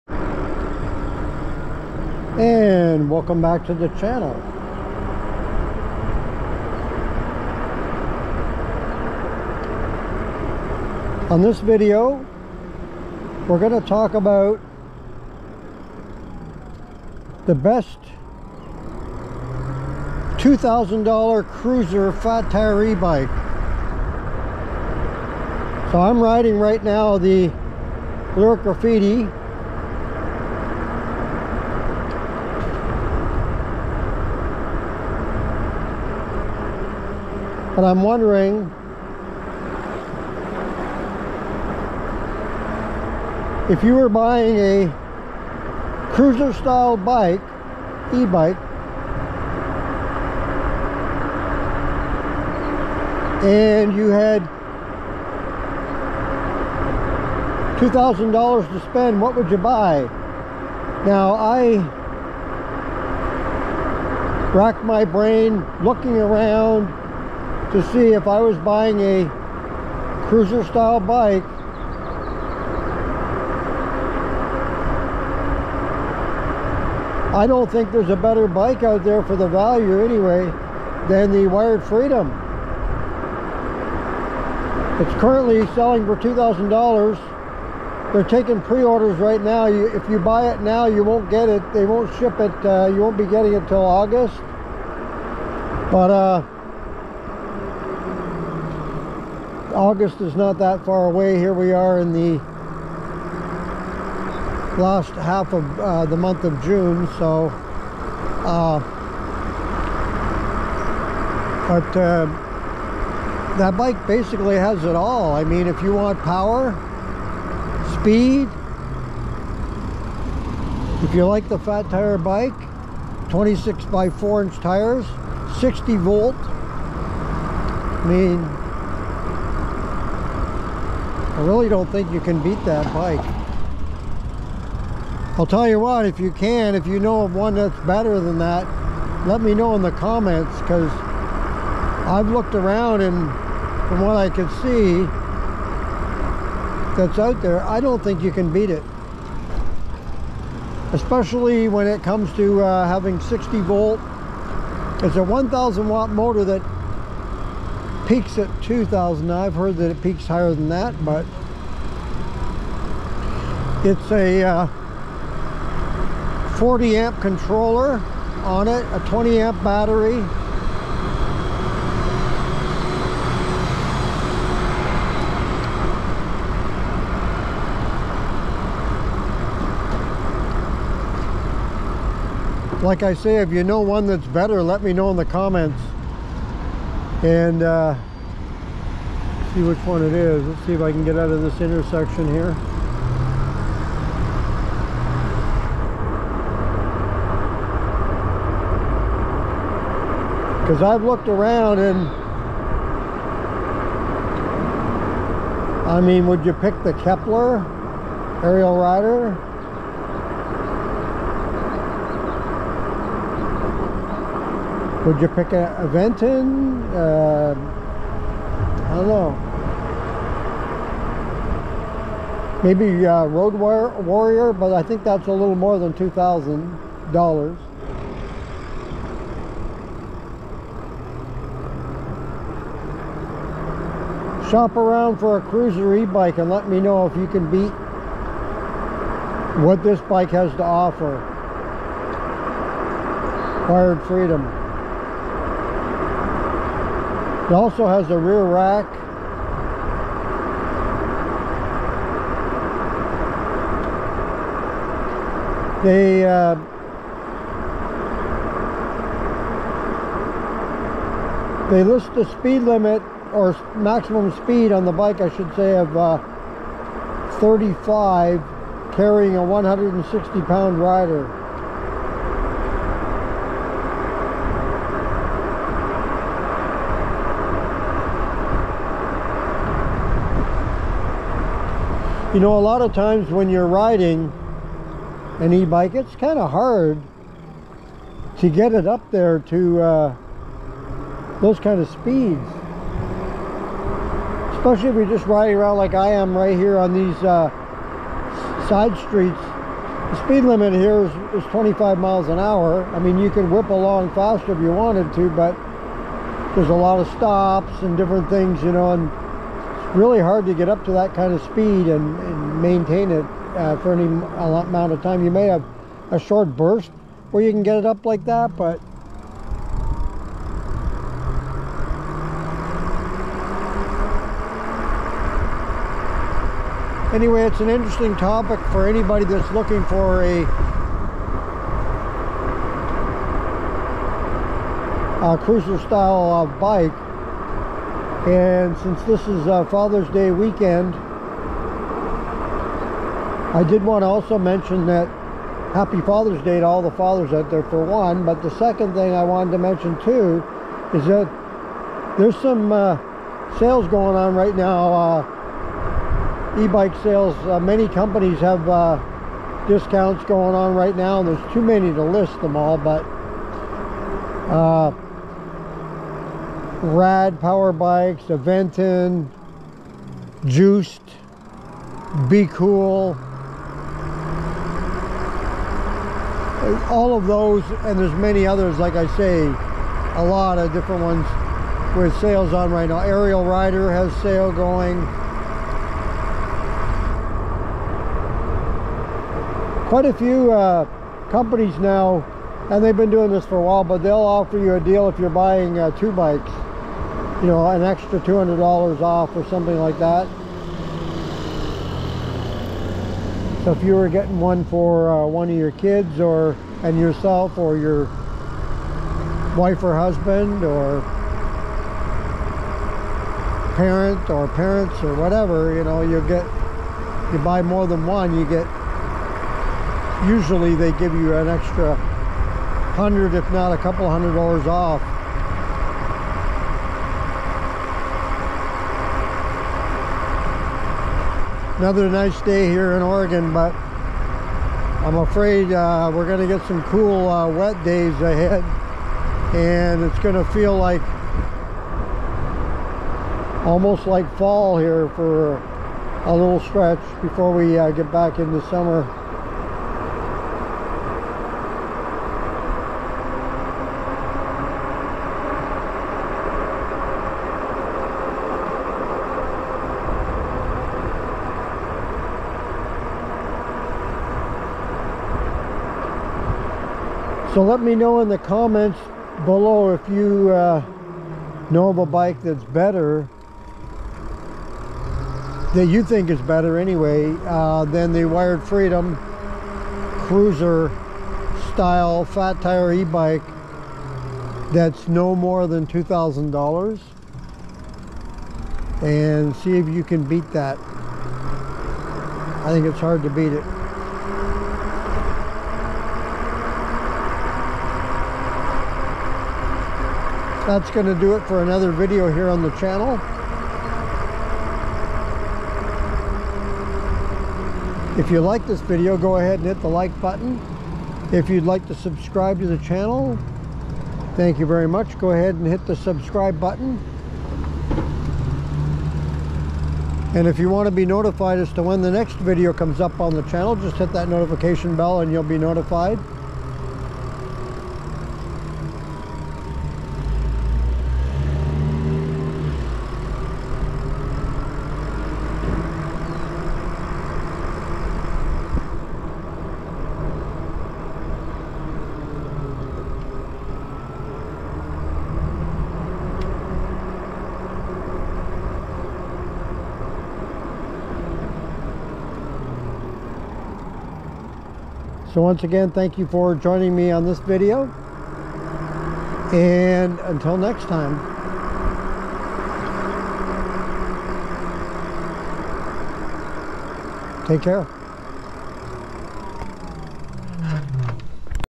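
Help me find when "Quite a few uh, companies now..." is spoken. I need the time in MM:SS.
06:29.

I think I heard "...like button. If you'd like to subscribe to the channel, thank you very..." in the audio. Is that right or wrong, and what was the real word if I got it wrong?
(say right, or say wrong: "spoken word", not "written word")
right.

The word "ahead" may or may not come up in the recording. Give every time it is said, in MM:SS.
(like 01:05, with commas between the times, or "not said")
07:18, 08:29, 08:35.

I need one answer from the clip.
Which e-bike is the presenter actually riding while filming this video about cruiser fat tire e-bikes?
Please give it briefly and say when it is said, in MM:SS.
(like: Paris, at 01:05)
Lyric Graffiti, at 00:28.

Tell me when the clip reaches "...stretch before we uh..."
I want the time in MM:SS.
07:26.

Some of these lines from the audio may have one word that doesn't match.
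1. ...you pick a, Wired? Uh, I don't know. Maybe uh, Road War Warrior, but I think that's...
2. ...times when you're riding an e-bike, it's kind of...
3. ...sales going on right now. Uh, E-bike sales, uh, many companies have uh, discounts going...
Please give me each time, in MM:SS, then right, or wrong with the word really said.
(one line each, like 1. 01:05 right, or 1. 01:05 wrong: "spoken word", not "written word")
1. 03:35 wrong: "Venton", not "Wired"
2. 04:42 right
3. 05:53 right.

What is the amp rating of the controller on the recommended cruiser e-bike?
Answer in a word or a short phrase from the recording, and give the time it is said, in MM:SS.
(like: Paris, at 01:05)
40 amp, at 02:46.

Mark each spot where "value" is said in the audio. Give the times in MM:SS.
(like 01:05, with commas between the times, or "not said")
01:19.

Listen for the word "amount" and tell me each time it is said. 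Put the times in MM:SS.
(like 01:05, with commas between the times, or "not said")
05:14.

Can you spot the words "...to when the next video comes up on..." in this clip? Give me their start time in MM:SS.
08:41.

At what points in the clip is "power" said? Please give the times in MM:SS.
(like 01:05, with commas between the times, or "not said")
01:56, 06:07.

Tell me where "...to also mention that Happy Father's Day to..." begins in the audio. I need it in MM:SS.
05:44.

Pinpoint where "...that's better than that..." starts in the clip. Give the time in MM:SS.
02:17.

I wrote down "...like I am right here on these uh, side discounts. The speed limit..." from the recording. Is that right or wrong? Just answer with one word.
wrong.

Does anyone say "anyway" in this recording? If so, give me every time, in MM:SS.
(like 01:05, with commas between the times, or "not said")
01:20, 05:27, 07:56.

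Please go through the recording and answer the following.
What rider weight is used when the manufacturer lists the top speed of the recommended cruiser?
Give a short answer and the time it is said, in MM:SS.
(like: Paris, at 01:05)
160 pounds, at 04:29.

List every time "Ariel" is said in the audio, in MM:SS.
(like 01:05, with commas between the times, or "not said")
03:28, 06:22.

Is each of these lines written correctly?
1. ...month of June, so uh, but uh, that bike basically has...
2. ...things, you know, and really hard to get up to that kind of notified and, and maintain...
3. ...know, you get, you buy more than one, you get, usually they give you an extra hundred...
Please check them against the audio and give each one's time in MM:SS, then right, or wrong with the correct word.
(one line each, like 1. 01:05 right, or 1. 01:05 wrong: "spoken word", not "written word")
1. 01:46 right
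2. 05:08 wrong: "speed", not "notified"
3. 06:55 right.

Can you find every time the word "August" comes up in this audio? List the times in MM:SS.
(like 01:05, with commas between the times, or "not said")
01:33, 01:39.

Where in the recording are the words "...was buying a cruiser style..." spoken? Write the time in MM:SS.
01:08.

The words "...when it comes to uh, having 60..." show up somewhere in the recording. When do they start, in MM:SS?
02:31.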